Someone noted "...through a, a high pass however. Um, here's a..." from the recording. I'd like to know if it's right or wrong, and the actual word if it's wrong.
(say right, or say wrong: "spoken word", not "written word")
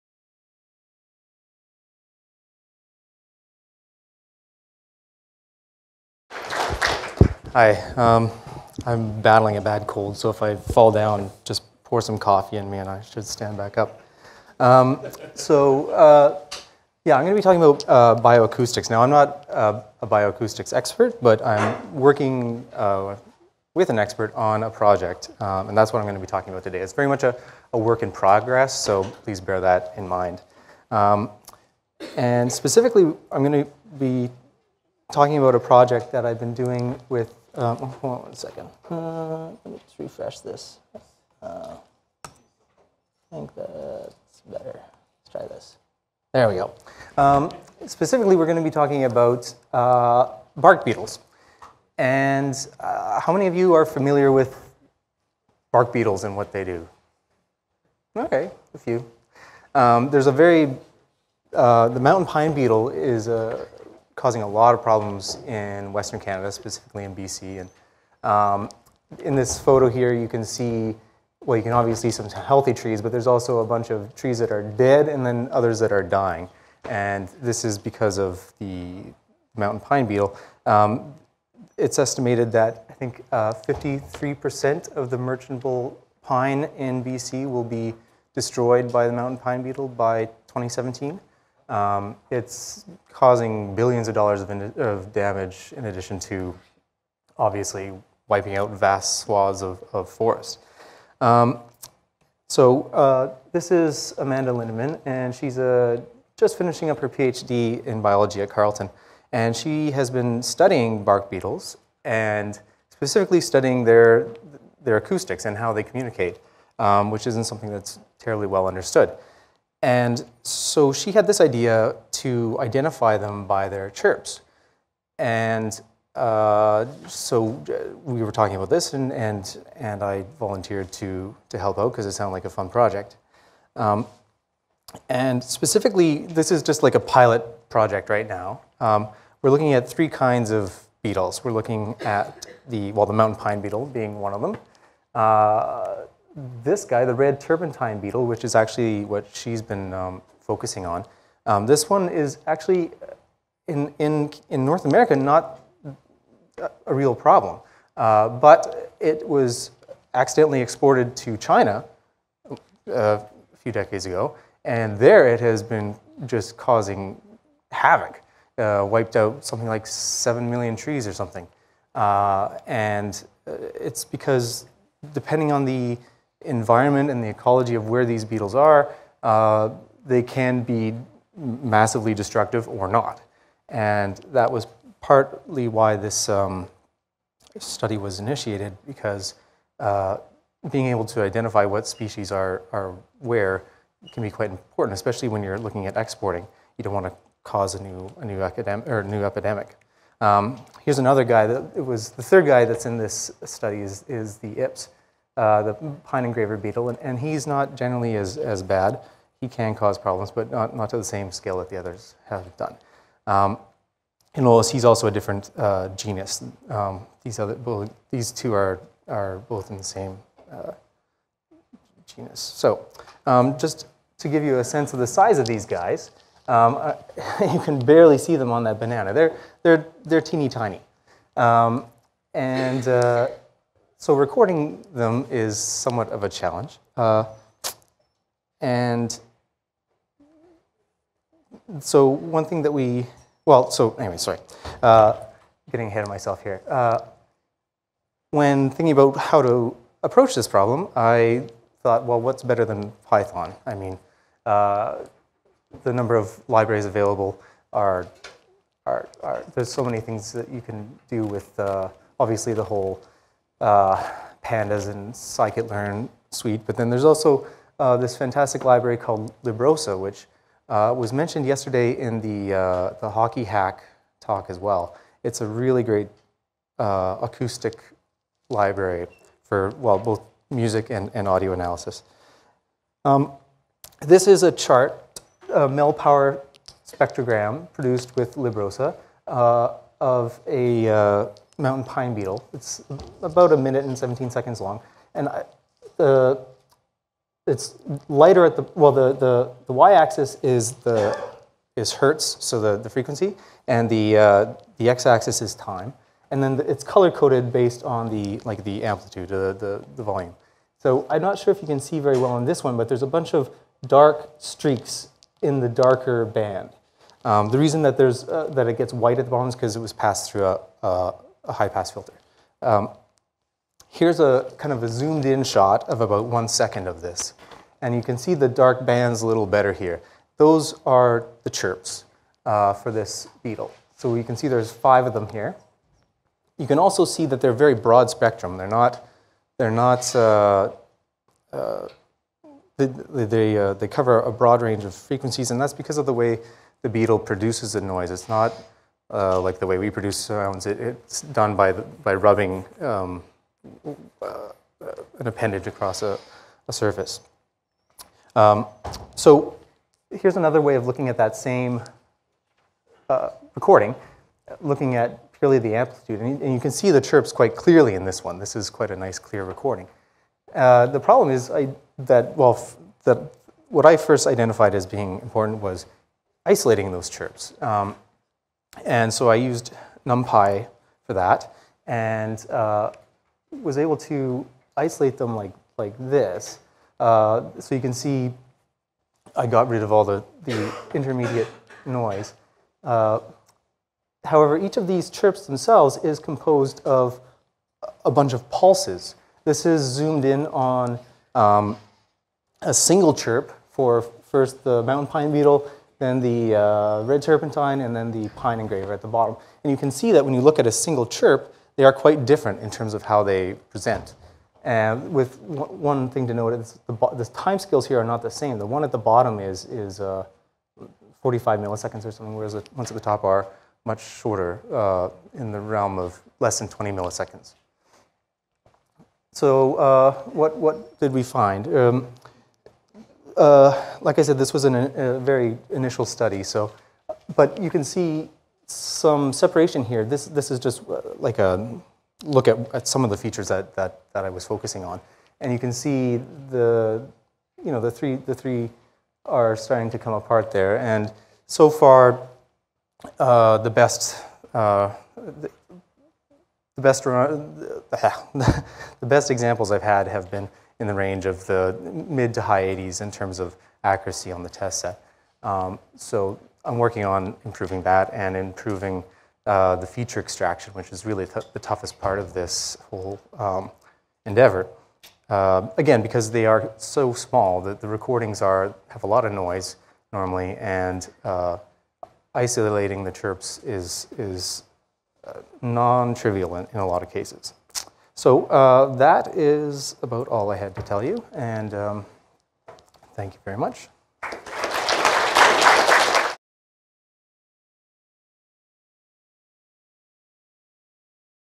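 wrong: "filter", not "however".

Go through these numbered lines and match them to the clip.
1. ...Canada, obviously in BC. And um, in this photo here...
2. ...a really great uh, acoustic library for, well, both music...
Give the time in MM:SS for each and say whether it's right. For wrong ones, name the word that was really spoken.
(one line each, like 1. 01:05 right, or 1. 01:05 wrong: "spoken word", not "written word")
1. 01:06 wrong: "specifically", not "obviously"
2. 04:35 right.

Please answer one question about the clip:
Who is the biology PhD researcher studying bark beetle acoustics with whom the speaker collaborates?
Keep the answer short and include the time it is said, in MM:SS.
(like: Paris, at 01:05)
Amanda Lindeman, at 01:44.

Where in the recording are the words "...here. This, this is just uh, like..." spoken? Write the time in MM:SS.
07:19.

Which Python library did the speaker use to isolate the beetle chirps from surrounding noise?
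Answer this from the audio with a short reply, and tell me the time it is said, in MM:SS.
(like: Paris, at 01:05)
NumPy, at 06:20.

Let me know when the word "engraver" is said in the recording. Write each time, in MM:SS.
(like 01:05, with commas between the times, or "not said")
03:26, 06:48.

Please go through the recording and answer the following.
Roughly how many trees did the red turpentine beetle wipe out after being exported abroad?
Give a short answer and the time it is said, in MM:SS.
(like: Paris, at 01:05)
7 million, at 02:49.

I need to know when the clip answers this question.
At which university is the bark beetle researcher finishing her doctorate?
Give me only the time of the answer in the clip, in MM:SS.
01:48.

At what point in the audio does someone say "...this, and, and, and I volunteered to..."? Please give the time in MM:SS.
02:08.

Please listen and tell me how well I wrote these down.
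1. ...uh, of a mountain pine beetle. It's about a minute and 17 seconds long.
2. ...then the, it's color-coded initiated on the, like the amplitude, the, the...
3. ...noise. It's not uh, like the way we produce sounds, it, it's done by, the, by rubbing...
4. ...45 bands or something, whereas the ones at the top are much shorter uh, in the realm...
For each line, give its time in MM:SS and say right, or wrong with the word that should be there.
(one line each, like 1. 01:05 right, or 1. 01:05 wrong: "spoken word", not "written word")
1. 04:49 right
2. 05:06 wrong: "based", not "initiated"
3. 05:47 right
4. 07:01 wrong: "milliseconds", not "bands".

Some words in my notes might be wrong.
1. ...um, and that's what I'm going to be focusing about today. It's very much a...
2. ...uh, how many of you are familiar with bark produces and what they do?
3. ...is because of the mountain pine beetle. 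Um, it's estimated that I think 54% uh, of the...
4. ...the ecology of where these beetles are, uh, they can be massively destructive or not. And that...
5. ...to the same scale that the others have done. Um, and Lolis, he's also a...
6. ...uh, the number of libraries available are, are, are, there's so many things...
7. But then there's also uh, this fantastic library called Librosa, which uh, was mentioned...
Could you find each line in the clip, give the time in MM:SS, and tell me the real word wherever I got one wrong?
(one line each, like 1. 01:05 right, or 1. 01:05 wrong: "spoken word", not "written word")
1. 00:25 wrong: "talking", not "focusing"
2. 00:52 wrong: "beetles", not "produces"
3. 01:17 wrong: "53", not "54"
4. 02:57 right
5. 03:30 right
6. 04:14 right
7. 04:26 right.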